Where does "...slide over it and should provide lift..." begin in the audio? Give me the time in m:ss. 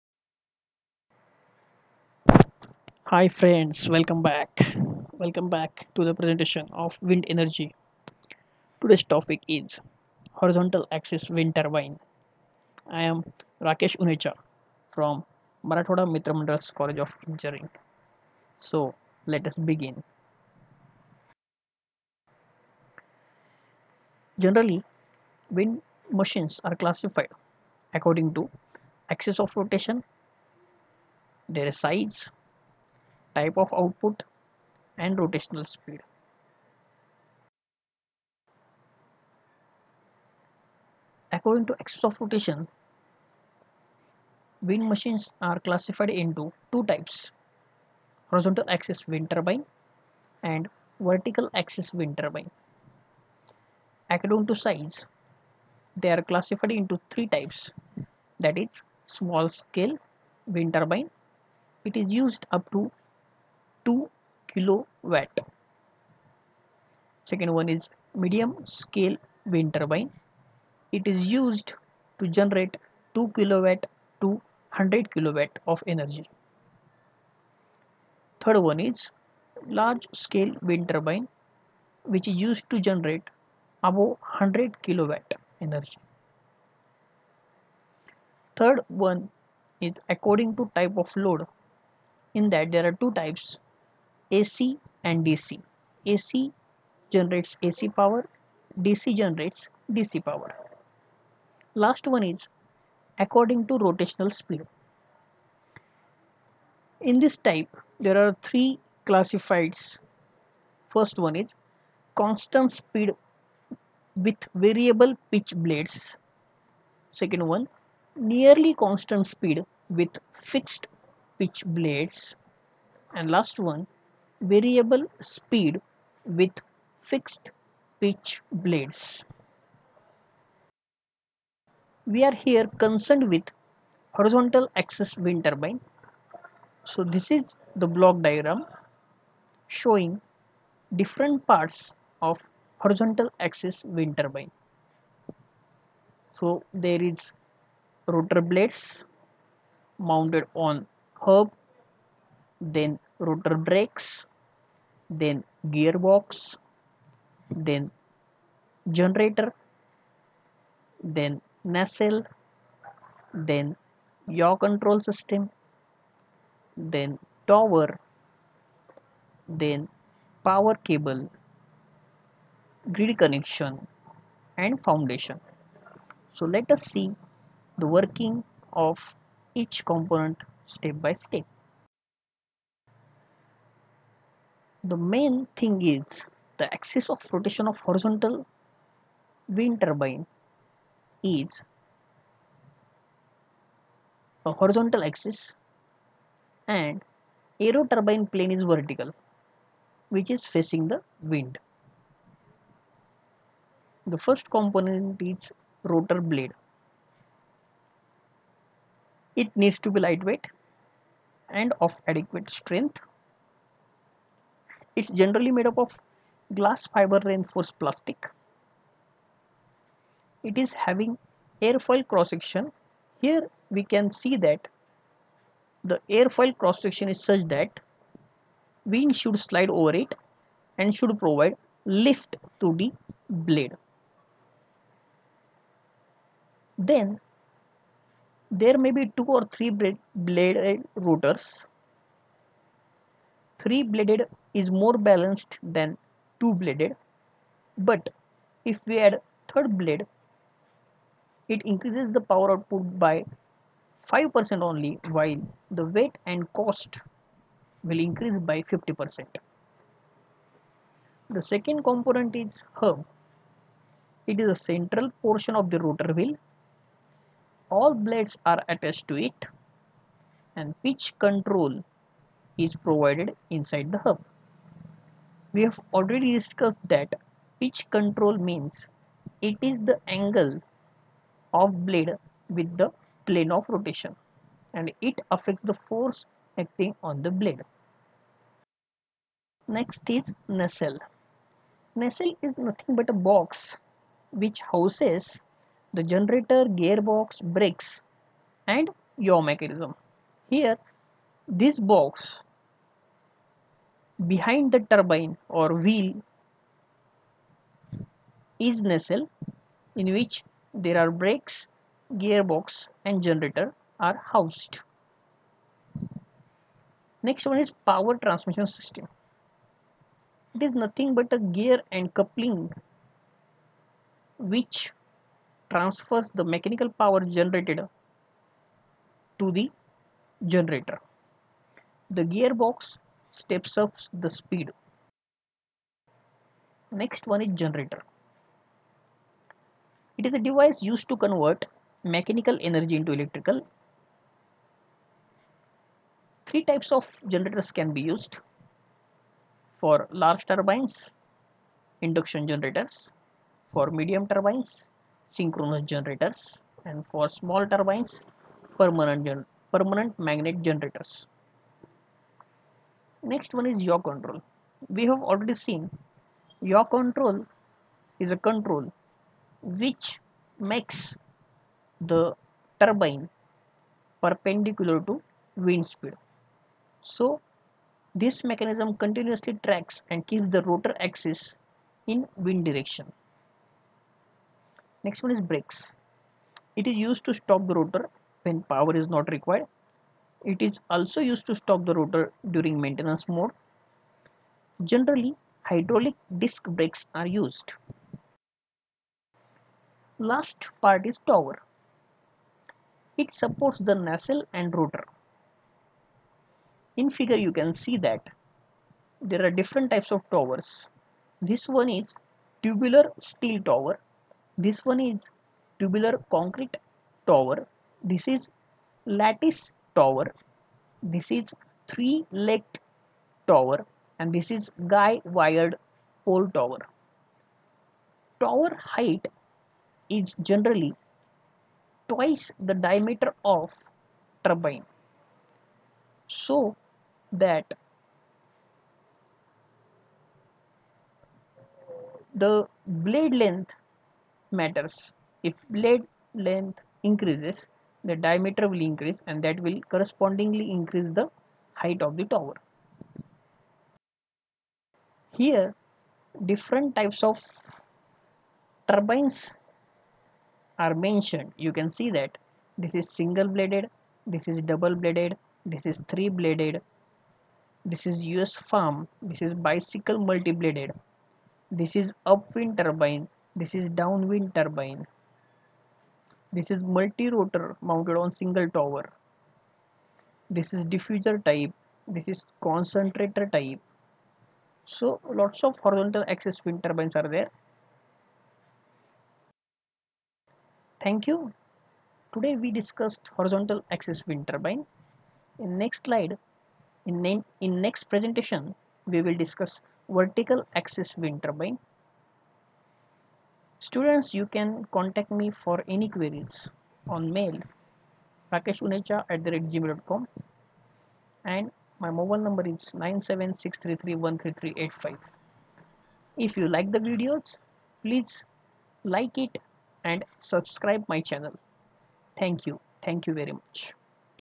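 3:49.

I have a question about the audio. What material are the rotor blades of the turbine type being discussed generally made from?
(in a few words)
glass fiber reinforced plastic.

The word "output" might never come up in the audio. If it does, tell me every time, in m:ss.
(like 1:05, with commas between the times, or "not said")
0:33, 4:12.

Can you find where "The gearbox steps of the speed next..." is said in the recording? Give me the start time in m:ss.
5:32.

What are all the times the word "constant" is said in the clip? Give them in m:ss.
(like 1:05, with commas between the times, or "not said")
1:52, 1:58.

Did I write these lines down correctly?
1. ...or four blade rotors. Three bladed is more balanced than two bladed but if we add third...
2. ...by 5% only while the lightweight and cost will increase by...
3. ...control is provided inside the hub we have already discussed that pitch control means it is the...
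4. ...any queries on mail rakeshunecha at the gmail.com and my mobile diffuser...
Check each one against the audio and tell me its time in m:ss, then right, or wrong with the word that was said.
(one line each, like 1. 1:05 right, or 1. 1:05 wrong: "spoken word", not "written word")
1. 3:59 wrong: "three", not "four"
2. 4:13 wrong: "weight", not "lightweight"
3. 4:31 right
4. 8:25 wrong: "number", not "diffuser".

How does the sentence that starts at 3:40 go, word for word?
It is having airfoil cross section.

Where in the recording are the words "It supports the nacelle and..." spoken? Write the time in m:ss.
6:43.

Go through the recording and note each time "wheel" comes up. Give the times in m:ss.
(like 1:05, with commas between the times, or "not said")
4:26, 5:05.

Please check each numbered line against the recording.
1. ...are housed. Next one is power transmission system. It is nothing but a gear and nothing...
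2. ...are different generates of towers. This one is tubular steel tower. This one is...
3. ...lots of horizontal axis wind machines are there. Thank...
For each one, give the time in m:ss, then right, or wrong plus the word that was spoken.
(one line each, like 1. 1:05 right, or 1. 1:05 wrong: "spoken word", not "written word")
1. 5:13 wrong: "coupling", not "nothing"
2. 6:49 wrong: "types", not "generates"
3. 8:05 wrong: "turbines", not "machines".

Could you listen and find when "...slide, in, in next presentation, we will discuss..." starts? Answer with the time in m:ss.
8:16.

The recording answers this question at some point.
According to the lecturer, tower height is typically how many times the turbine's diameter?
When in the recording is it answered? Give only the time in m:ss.
7:12.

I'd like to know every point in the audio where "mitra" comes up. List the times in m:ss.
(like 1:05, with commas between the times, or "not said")
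0:16.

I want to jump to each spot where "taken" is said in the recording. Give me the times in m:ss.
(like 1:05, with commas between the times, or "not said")
not said.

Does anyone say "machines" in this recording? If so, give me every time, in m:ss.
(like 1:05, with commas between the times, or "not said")
0:26, 0:44.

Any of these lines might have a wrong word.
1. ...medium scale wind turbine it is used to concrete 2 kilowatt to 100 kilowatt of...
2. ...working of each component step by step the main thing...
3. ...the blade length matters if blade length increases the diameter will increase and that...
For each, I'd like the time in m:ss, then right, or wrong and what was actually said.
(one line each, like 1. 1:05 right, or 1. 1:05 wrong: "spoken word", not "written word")
1. 1:08 wrong: "generate", not "concrete"
2. 2:57 right
3. 7:22 right.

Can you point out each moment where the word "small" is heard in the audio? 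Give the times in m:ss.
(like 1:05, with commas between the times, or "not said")
0:59, 5:57.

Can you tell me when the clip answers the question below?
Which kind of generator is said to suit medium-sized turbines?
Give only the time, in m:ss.
5:55.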